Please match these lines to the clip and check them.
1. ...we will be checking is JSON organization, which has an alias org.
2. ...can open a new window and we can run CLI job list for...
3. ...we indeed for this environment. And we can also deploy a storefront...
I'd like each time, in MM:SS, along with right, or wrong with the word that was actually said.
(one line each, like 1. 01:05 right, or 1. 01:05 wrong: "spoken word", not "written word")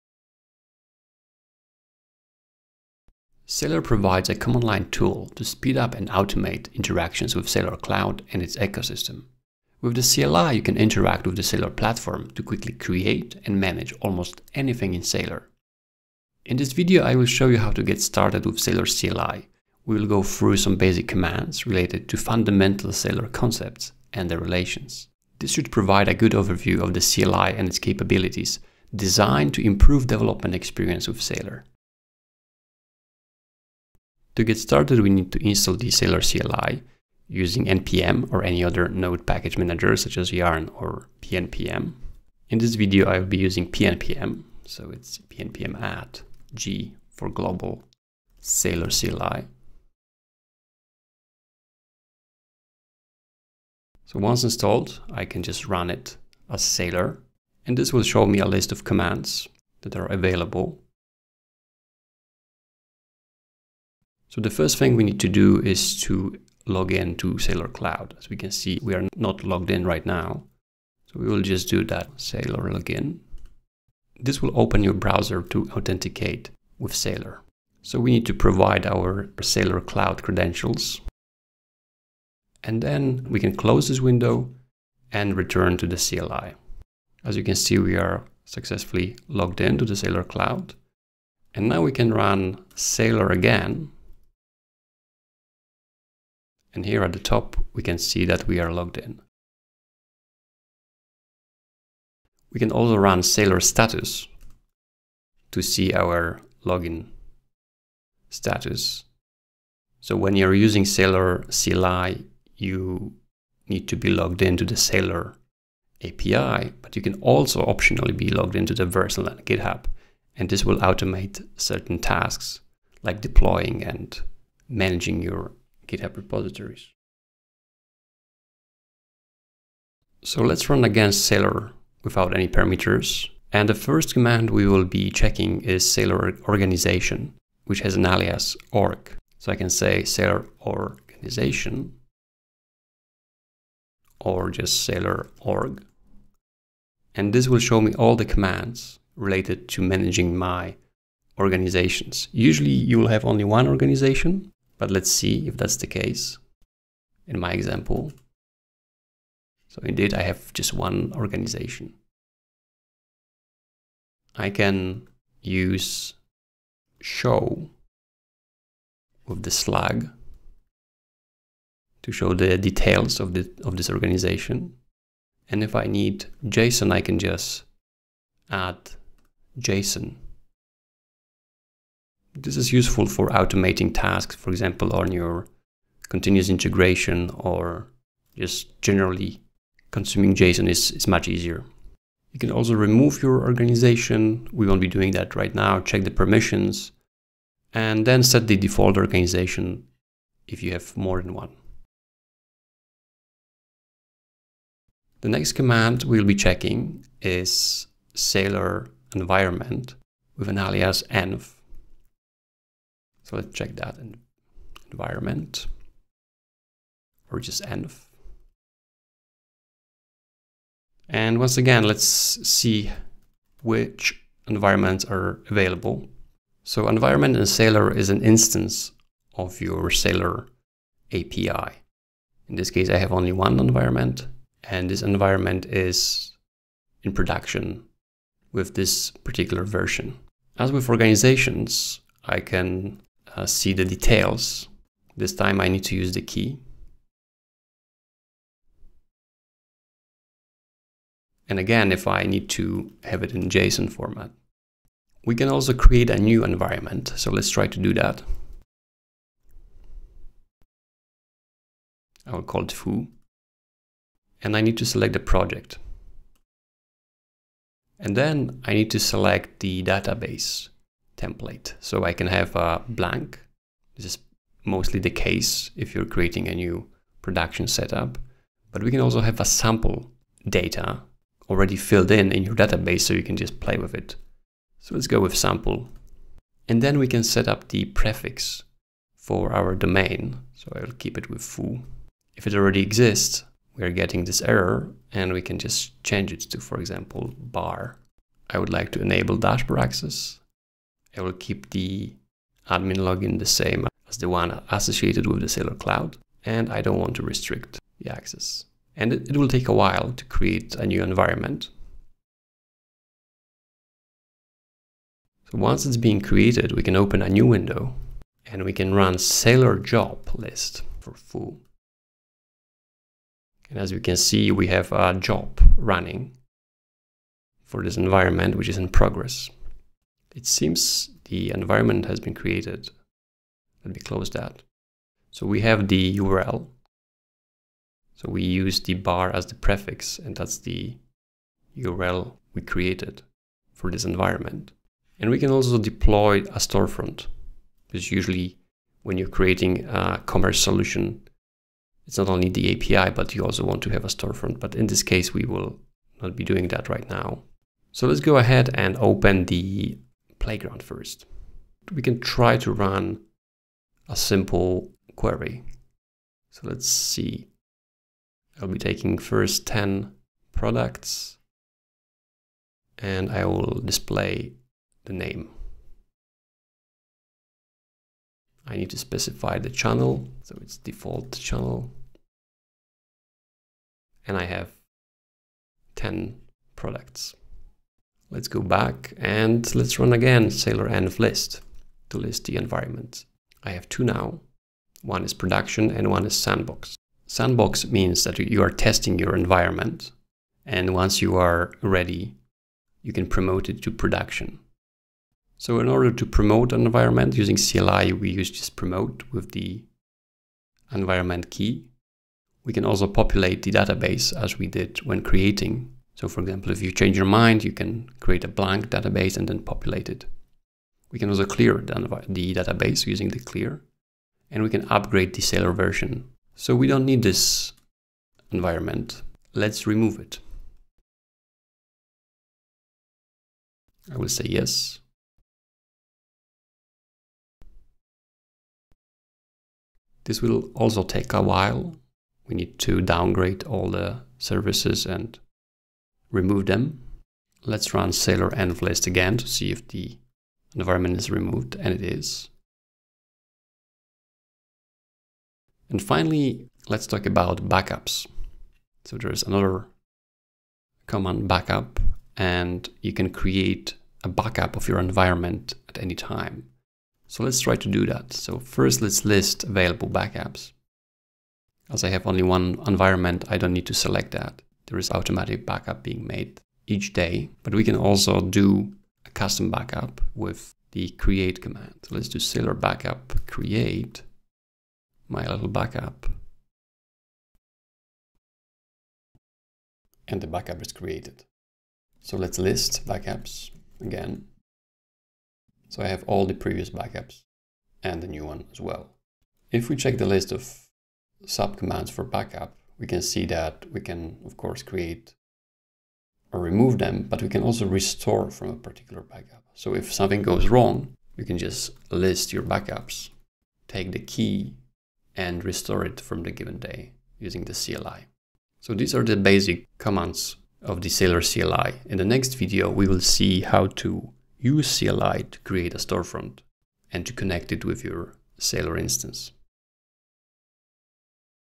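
1. 02:14 wrong: "Saleor", not "JSON"
2. 05:16 wrong: "Saleor", not "CLI"
3. 05:42 wrong: "created", not "indeed".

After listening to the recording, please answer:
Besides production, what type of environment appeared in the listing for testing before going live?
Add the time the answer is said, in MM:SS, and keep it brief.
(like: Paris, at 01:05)
sandbox, at 06:36.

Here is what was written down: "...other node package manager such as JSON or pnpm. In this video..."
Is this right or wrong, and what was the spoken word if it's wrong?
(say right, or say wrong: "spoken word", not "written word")
wrong: "Yarn", not "JSON".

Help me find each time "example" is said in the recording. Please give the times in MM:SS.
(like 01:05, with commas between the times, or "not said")
02:37, 03:04, 04:56, 06:56.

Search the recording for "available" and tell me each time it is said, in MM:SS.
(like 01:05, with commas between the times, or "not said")
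01:00, 03:45, 07:49.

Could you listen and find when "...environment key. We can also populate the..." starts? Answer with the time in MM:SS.
06:50.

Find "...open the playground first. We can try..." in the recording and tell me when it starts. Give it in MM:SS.
05:58.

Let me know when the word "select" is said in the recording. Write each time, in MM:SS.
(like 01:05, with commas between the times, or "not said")
04:24, 04:28, 07:53.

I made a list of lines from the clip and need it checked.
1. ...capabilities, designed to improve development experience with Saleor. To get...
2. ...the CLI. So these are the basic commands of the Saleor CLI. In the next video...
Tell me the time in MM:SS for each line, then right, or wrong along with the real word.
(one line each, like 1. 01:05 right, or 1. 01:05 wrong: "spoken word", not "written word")
1. 00:27 right
2. 08:37 right.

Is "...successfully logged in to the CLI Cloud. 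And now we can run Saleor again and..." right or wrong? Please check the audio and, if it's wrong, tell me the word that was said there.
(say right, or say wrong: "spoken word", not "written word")
wrong: "Saleor", not "CLI".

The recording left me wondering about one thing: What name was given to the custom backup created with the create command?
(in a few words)
my little backup.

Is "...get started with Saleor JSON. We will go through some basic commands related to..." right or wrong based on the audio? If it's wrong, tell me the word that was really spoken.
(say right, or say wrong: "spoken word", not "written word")
wrong: "CLI", not "JSON".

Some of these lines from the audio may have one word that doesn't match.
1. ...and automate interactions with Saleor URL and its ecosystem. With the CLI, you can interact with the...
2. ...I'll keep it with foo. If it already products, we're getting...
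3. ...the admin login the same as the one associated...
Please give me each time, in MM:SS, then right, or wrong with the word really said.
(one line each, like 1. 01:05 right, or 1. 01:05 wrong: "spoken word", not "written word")
1. 00:05 wrong: "Cloud", not "URL"
2. 04:50 wrong: "exists", not "products"
3. 05:01 right.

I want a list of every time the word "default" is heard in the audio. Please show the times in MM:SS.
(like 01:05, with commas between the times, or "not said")
03:18, 06:20.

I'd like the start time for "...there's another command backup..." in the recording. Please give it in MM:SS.
07:39.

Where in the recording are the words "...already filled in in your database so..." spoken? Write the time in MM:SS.
04:41.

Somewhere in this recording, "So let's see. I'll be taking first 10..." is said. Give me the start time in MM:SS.
06:06.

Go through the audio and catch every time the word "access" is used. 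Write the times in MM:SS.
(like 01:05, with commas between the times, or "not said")
04:59, 05:08.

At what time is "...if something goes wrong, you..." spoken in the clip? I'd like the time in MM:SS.
08:29.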